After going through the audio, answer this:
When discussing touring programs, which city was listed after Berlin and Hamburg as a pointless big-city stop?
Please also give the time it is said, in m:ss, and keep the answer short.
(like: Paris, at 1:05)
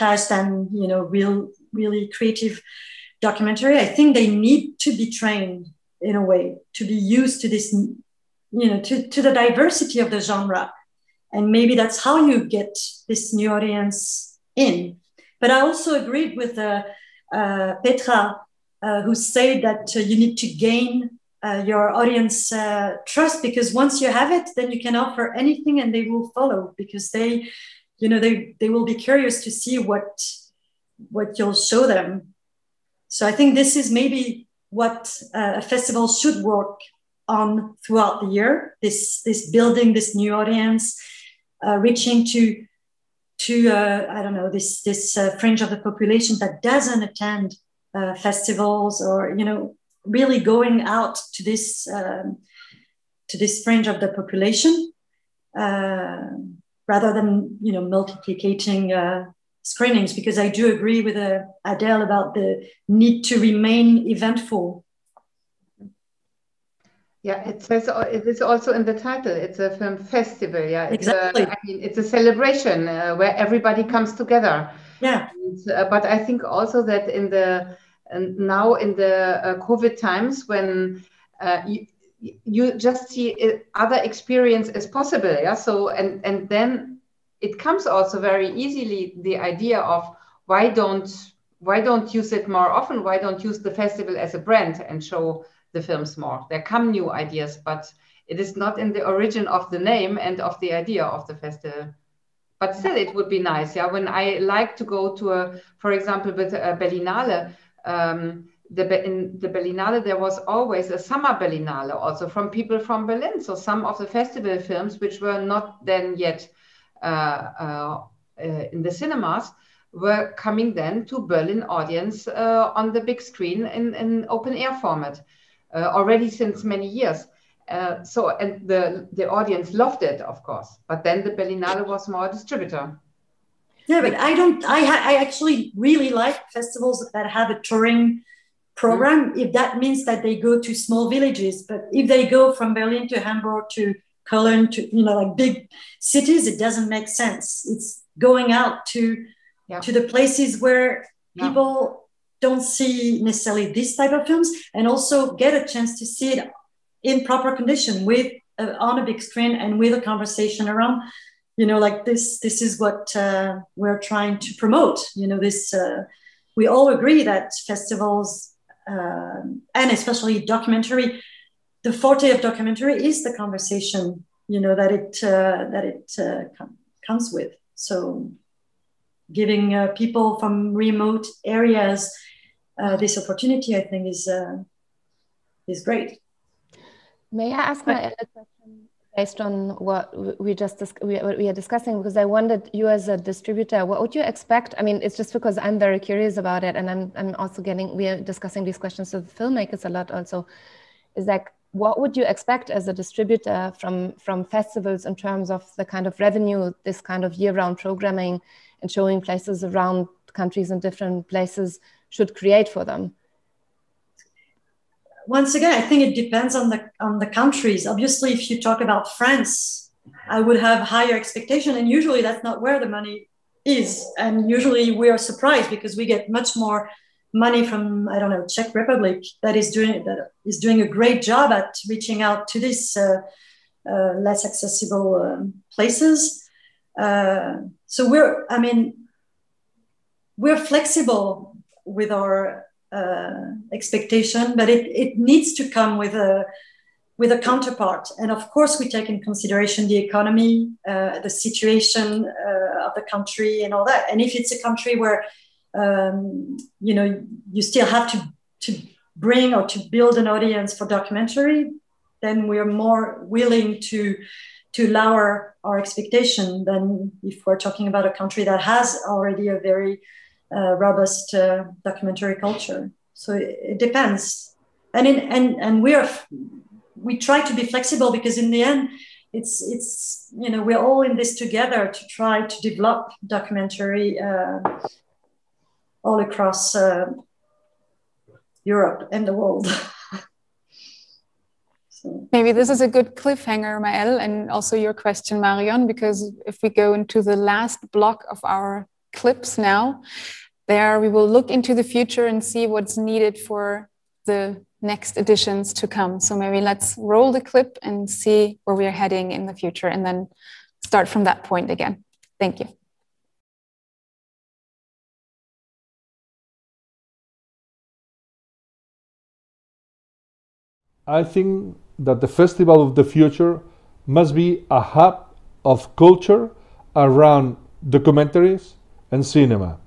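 Cologne, at 2:24.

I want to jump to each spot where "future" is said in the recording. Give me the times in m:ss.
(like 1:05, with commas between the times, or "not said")
5:01, 5:09, 5:23.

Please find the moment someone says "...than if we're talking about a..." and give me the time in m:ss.
4:26.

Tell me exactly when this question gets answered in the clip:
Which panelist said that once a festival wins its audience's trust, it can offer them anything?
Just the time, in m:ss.
0:17.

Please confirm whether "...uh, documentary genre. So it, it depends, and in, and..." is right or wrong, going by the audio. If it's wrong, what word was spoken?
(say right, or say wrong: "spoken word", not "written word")
wrong: "culture", not "genre".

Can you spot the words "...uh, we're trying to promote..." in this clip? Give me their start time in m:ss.
2:43.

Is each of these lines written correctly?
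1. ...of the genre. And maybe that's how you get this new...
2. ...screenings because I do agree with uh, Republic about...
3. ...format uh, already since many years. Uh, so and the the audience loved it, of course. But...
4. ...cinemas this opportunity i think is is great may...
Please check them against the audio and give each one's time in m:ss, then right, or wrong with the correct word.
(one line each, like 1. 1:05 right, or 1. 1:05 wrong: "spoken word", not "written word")
1. 0:09 right
2. 0:59 wrong: "Adele", not "Republic"
3. 2:04 right
4. 3:01 wrong: "areas", not "cinemas".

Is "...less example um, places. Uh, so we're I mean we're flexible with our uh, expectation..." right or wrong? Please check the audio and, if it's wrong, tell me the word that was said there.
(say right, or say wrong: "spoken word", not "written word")
wrong: "accessible", not "example".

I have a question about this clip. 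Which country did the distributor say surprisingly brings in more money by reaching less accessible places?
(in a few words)
Czech Republic.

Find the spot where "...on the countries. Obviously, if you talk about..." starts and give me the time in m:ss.
3:36.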